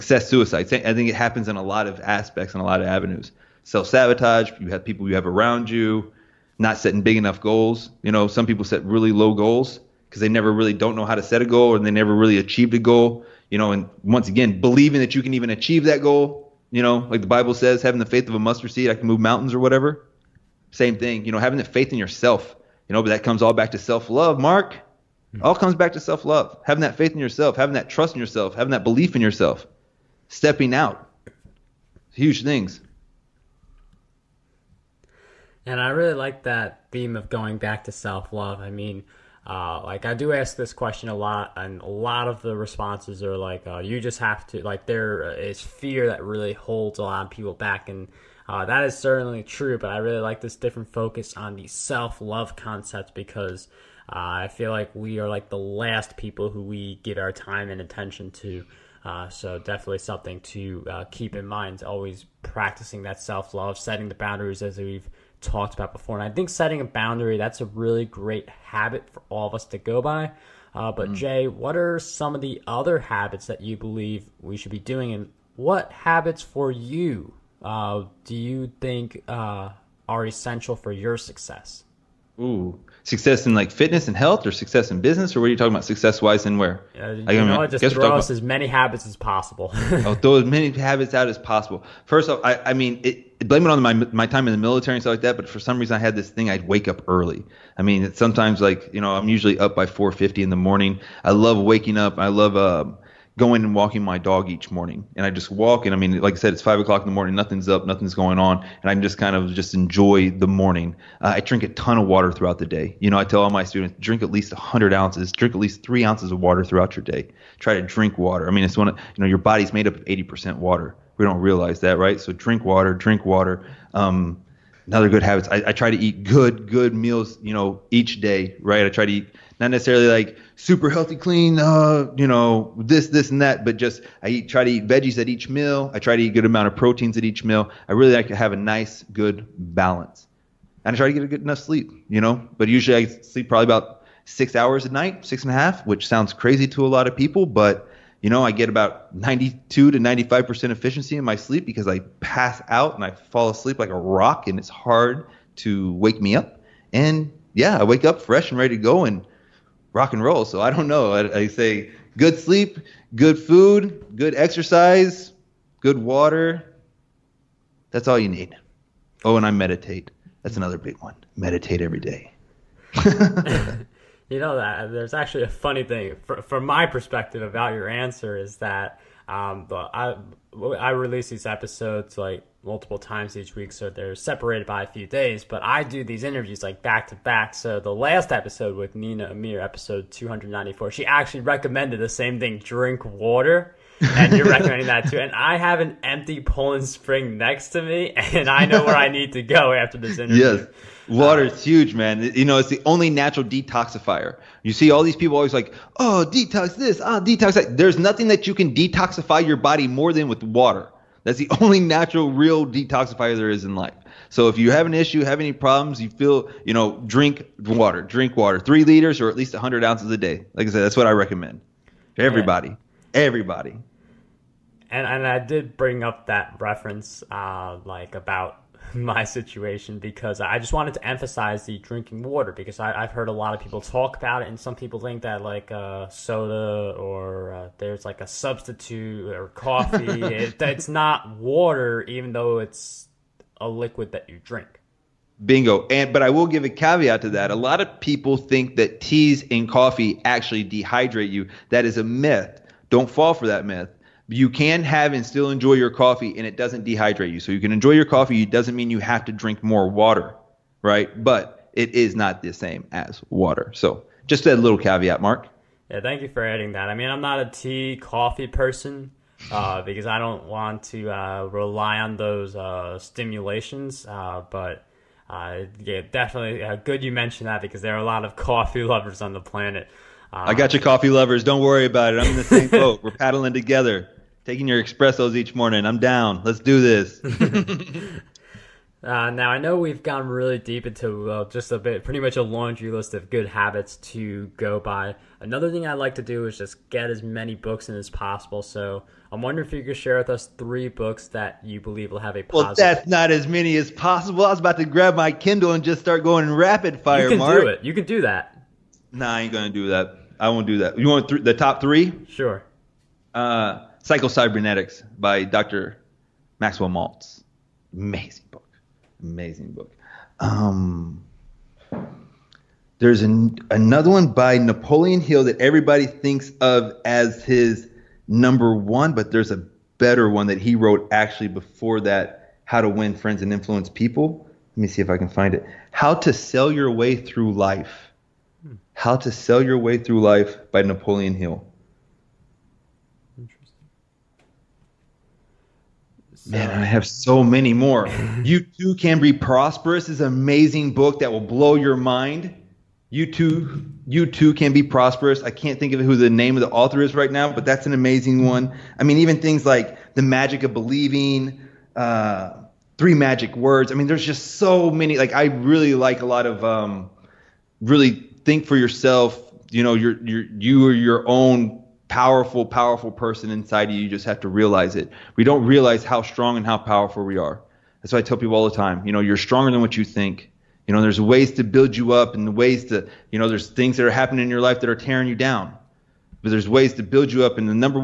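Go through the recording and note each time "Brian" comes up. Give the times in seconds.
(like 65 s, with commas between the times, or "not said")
not said.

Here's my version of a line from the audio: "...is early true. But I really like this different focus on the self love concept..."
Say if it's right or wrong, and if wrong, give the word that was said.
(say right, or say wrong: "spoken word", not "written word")
wrong: "certainly", not "early".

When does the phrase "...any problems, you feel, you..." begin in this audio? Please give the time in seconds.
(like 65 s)
215 s.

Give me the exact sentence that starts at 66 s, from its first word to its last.
And I think setting a boundary that's a really great habit for all of us to go by.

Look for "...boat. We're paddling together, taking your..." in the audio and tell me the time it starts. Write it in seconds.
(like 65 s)
282 s.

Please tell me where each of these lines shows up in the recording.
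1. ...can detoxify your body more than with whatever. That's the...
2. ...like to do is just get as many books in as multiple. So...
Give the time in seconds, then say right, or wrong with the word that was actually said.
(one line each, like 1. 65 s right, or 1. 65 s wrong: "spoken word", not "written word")
1. 208 s wrong: "water", not "whatever"
2. 295 s wrong: "possible", not "multiple".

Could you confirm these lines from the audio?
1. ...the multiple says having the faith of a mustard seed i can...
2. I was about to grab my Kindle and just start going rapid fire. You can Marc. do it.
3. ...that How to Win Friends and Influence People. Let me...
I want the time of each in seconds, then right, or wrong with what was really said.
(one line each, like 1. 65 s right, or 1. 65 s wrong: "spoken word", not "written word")
1. 17 s wrong: "bible", not "multiple"
2. 304 s right
3. 332 s right.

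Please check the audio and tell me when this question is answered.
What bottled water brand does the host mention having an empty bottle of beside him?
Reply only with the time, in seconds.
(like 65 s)
196 s.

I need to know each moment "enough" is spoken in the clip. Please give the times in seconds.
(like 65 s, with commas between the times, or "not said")
7 s, 141 s.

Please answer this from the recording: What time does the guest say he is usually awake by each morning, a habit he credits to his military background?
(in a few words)
4:50.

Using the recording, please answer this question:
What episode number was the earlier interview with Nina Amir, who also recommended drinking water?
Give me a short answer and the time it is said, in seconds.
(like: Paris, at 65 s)
294, at 190 s.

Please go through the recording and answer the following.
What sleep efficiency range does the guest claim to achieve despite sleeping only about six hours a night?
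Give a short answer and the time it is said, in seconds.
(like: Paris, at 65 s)
92 to 95%, at 149 s.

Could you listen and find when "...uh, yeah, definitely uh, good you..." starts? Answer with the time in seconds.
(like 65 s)
275 s.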